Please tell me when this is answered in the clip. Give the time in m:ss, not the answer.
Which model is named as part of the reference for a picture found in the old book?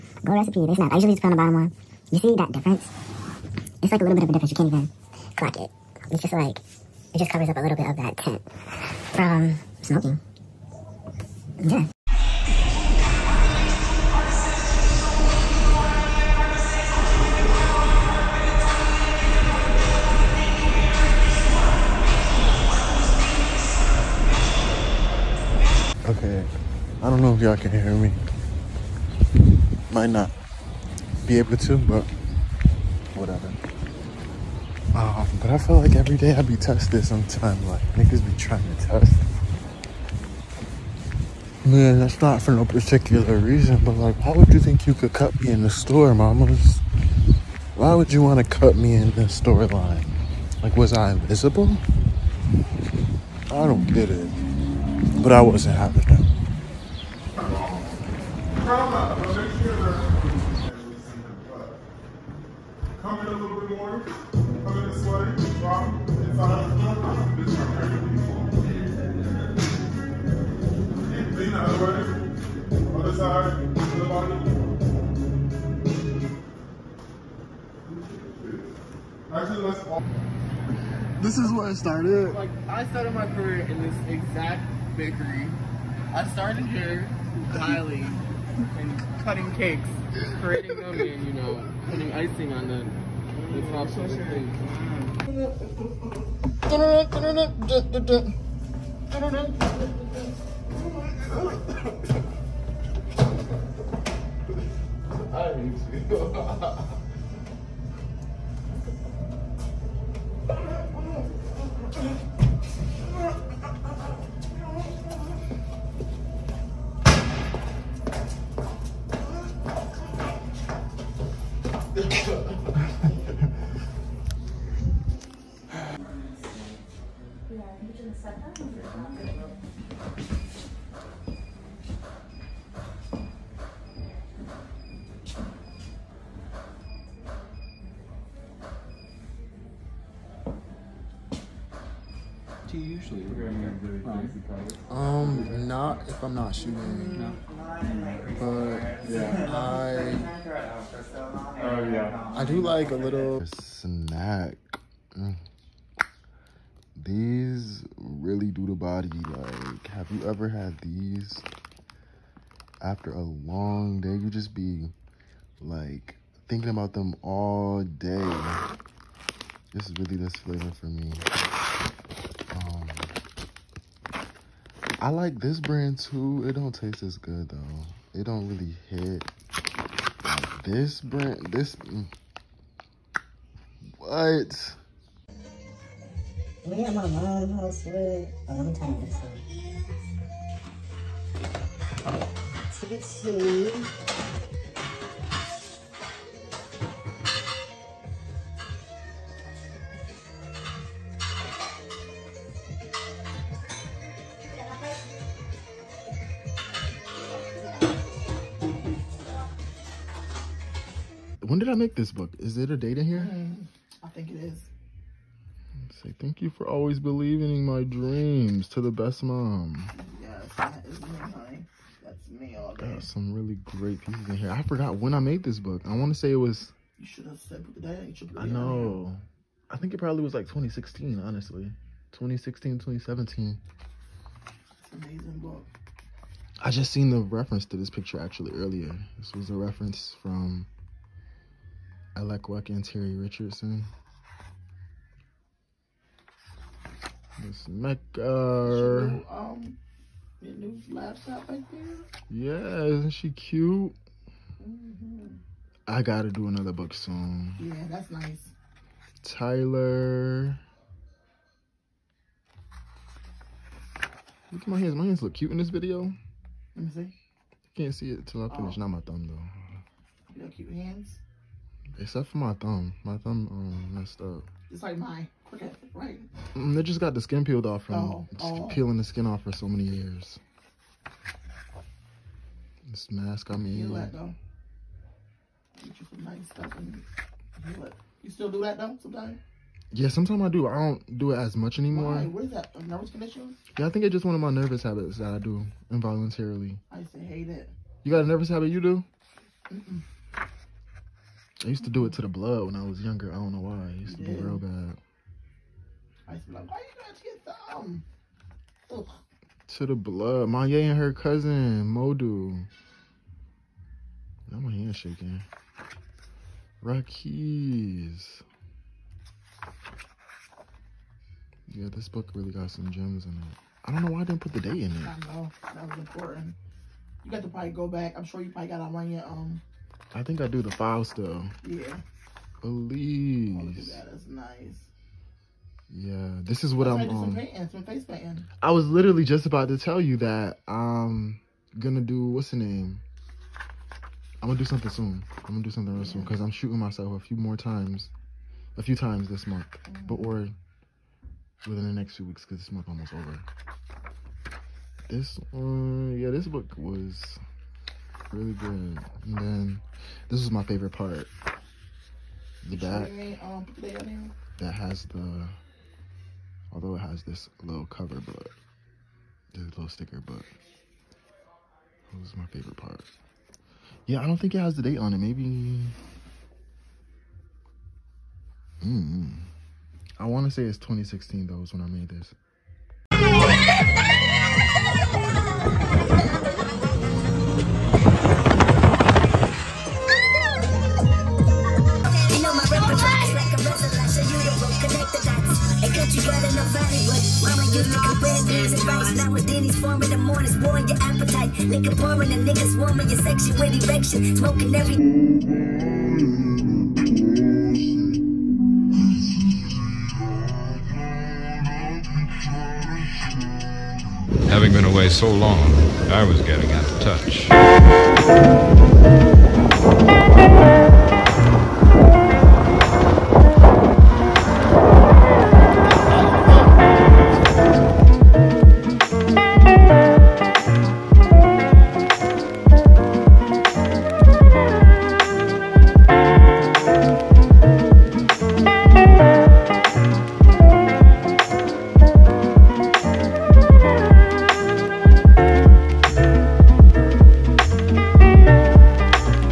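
4:02.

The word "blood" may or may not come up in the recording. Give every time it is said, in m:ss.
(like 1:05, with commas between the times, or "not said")
5:02, 5:09.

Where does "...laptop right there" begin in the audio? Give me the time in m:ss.
4:10.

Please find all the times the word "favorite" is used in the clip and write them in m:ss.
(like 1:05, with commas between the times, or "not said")
6:00, 6:12.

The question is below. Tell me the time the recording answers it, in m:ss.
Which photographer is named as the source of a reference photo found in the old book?
4:02.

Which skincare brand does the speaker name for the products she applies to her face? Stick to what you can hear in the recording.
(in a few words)
Glow Recipe.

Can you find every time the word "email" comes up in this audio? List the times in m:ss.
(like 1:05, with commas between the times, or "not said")
not said.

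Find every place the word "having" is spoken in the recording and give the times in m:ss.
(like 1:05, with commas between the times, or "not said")
0:55, 6:54.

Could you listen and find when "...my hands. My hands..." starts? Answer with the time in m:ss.
4:24.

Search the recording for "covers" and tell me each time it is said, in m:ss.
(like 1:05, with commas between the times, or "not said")
0:07, 6:07.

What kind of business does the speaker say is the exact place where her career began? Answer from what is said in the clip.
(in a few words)
bakery.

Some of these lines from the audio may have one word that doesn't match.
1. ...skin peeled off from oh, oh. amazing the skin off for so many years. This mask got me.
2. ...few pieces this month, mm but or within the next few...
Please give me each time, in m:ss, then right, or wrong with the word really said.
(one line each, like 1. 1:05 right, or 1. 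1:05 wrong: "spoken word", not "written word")
1. 4:37 wrong: "peeling", not "amazing"
2. 5:48 wrong: "times", not "pieces".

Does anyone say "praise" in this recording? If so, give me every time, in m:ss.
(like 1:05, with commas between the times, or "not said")
not said.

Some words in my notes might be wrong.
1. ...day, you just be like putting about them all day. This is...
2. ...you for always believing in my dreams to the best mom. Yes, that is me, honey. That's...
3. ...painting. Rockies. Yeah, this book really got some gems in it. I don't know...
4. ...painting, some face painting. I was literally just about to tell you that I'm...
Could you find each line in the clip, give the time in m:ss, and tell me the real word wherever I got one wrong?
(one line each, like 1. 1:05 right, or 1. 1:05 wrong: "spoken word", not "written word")
1. 2:43 wrong: "thinking", not "putting"
2. 3:36 right
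3. 5:14 wrong: "shaking", not "painting"
4. 5:37 right.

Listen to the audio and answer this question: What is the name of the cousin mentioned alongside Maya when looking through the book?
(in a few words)
Modu.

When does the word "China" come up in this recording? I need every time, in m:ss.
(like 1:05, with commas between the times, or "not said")
not said.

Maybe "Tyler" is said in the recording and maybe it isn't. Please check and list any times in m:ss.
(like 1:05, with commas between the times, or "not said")
4:19.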